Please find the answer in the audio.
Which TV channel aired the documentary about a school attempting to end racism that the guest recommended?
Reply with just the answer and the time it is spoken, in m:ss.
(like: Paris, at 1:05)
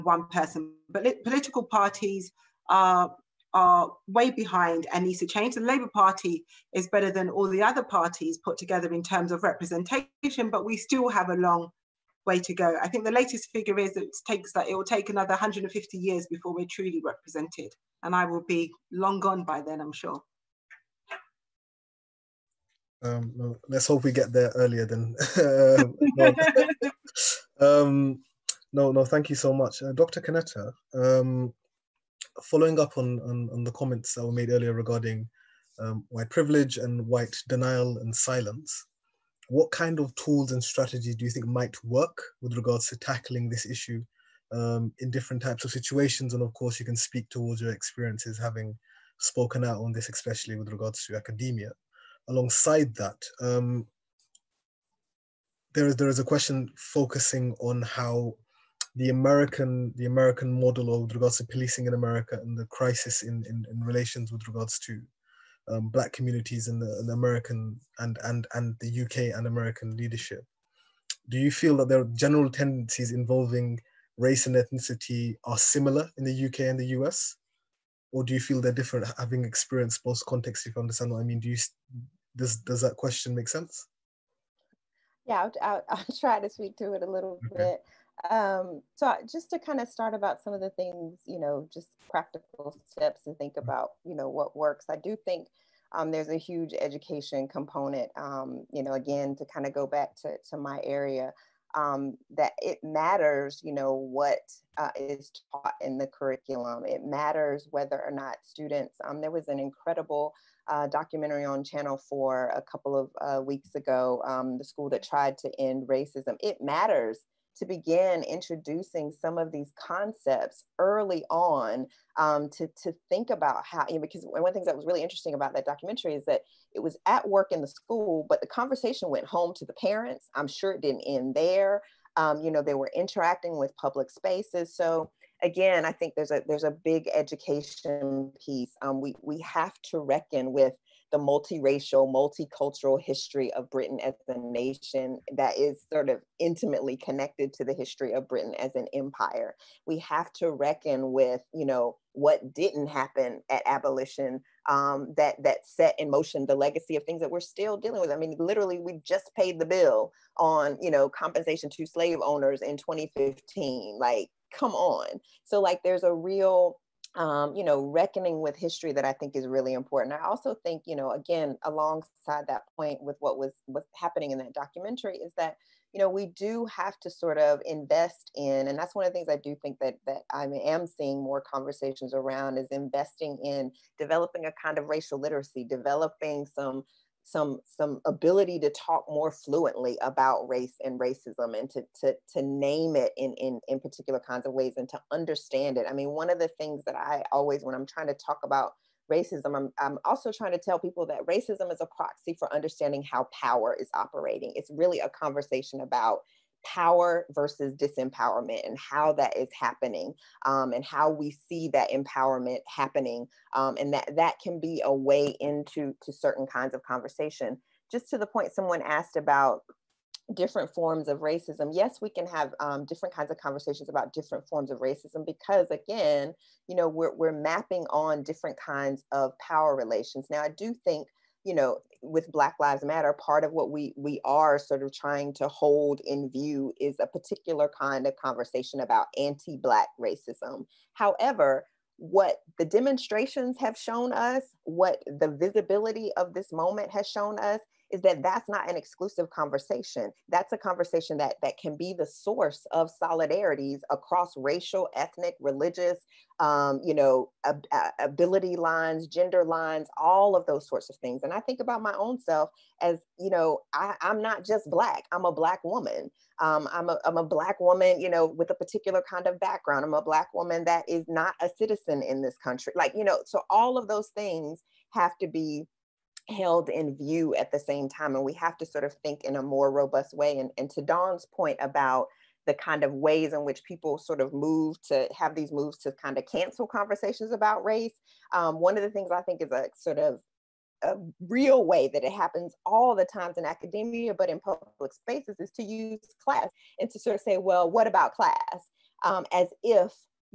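Channel 4, at 1:51.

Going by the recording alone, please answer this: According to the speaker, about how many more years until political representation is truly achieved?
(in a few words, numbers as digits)
150 years.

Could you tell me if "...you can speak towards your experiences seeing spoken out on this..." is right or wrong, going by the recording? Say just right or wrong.
wrong.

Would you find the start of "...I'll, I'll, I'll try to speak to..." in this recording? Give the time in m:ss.
1:25.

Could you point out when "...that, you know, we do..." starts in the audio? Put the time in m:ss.
2:55.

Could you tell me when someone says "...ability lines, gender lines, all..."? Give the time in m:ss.
4:17.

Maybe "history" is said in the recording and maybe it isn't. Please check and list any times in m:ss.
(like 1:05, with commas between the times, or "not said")
2:23, 2:27, 2:48.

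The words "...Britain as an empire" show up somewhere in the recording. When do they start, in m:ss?
2:28.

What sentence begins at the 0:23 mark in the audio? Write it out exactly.
Um, well, let's hope we get there earlier than.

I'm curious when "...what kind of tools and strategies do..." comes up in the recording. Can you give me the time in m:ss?
0:39.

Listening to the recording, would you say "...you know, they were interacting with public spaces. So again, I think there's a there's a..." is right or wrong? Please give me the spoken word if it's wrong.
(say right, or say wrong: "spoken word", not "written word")
right.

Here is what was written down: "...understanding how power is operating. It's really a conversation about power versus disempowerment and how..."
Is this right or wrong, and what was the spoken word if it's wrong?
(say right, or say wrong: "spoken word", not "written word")
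right.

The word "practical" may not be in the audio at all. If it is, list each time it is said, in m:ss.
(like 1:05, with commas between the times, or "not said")
1:32.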